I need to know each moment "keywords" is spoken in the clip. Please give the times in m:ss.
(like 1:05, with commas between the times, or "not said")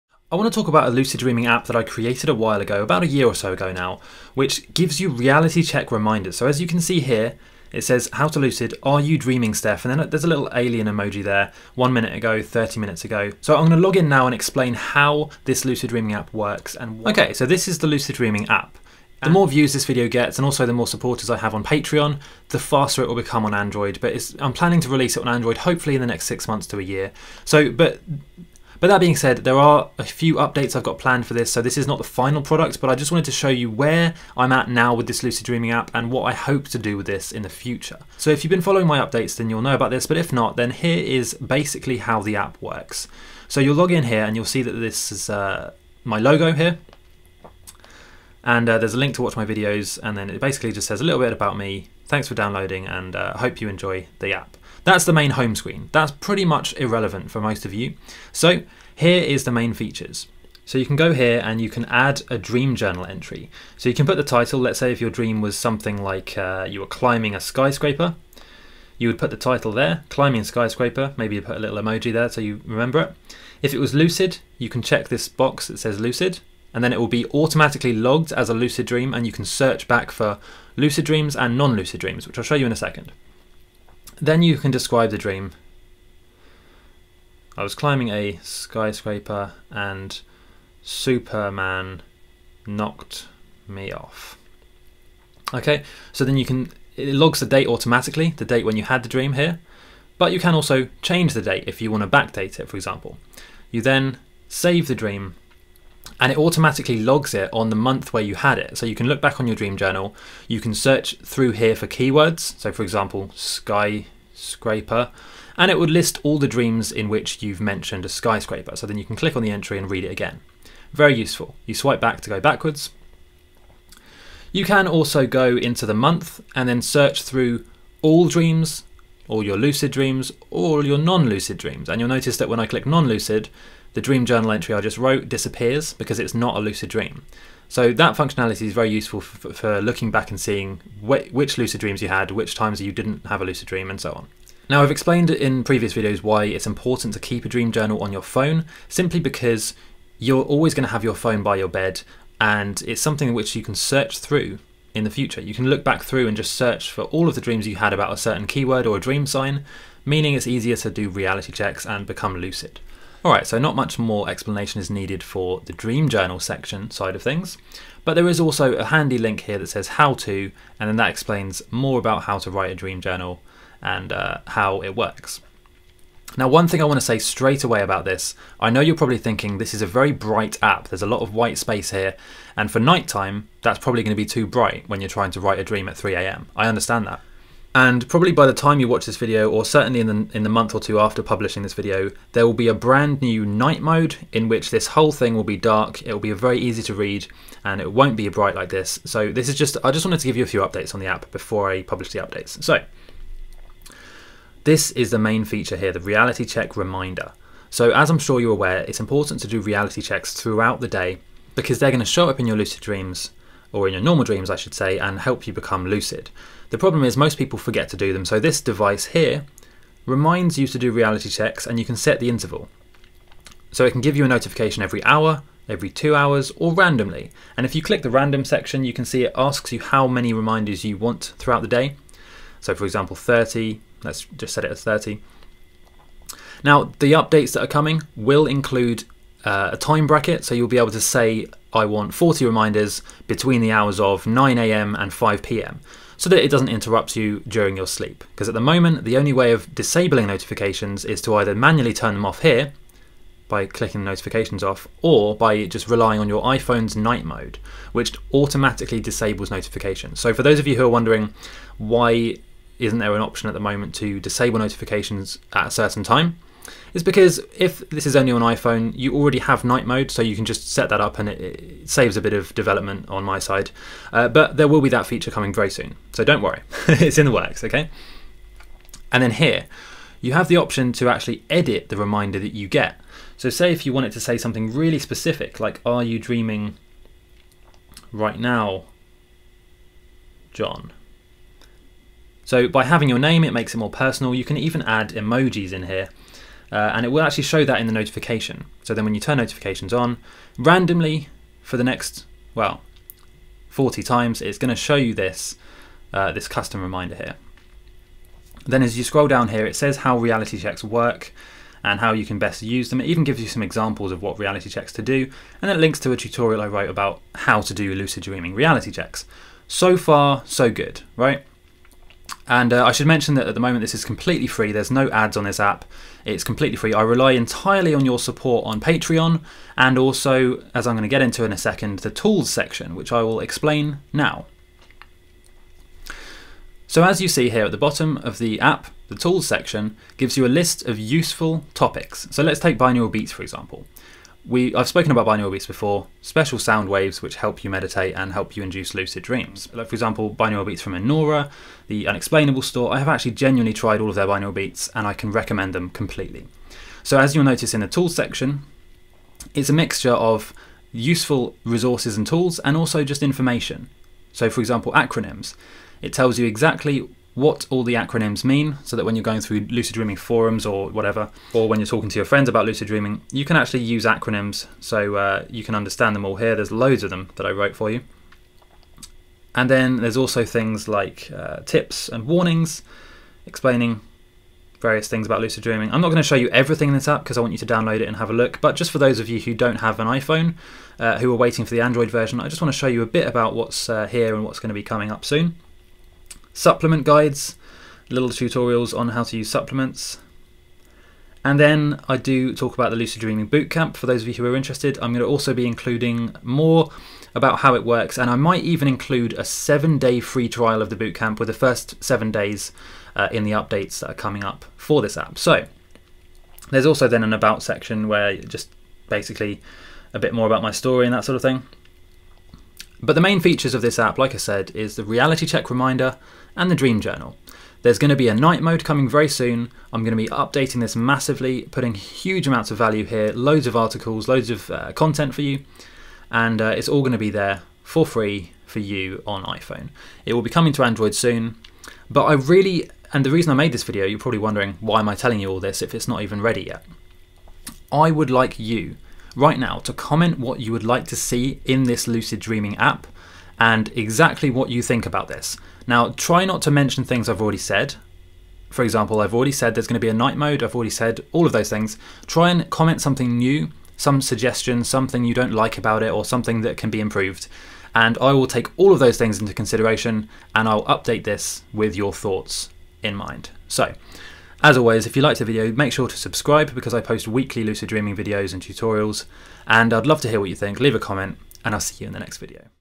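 1:51, 2:38.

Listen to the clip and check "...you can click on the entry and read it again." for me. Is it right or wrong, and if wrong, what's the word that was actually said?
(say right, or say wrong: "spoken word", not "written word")
right.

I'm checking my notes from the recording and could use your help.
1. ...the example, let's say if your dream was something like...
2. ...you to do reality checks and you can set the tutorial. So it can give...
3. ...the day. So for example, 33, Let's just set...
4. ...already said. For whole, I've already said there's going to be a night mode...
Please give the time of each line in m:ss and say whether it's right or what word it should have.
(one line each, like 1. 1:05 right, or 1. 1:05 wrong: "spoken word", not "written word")
1. 1:04 wrong: "title", not "example"
2. 3:40 wrong: "interval", not "tutorial"
3. 3:51 wrong: "30", not "33"
4. 7:37 wrong: "example", not "whole".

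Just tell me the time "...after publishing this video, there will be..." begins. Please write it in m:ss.
3:10.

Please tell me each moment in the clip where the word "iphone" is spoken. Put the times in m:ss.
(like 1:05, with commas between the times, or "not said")
4:16, 4:28, 6:30, 7:19.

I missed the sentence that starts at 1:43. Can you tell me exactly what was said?
You then save the dream and it automatically logs it on the month where you had it.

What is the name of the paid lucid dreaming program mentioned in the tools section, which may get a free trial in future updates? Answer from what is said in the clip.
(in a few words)
Lucid Dreaming Bootcamp.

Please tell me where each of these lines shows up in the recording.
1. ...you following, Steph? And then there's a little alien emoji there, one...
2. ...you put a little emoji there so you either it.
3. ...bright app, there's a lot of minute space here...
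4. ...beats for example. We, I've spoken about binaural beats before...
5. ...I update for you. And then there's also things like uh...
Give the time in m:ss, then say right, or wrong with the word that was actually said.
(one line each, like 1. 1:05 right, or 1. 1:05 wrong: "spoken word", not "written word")
1. 0:09 wrong: "dreaming", not "following"
2. 1:11 wrong: "remember", not "either"
3. 3:00 wrong: "white", not "minute"
4. 5:43 right
5. 6:17 wrong: "wrote", not "update".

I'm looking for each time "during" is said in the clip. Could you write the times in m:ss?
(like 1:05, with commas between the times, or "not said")
4:07.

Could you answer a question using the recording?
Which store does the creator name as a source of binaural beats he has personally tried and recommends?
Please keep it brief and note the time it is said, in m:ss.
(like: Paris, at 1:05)
the Unexplainable Store, at 5:51.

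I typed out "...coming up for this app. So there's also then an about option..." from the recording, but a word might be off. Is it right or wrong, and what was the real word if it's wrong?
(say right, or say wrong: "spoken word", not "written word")
wrong: "section", not "option".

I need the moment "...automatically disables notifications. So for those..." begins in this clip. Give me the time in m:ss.
4:18.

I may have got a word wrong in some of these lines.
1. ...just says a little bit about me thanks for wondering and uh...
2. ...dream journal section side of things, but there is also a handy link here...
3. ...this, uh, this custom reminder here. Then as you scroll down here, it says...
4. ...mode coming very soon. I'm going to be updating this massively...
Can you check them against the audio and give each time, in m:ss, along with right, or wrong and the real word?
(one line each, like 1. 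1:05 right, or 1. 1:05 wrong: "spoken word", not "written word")
1. 0:50 wrong: "downloading", not "wondering"
2. 2:45 right
3. 5:05 right
4. 7:08 right.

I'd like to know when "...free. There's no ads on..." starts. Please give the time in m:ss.
5:24.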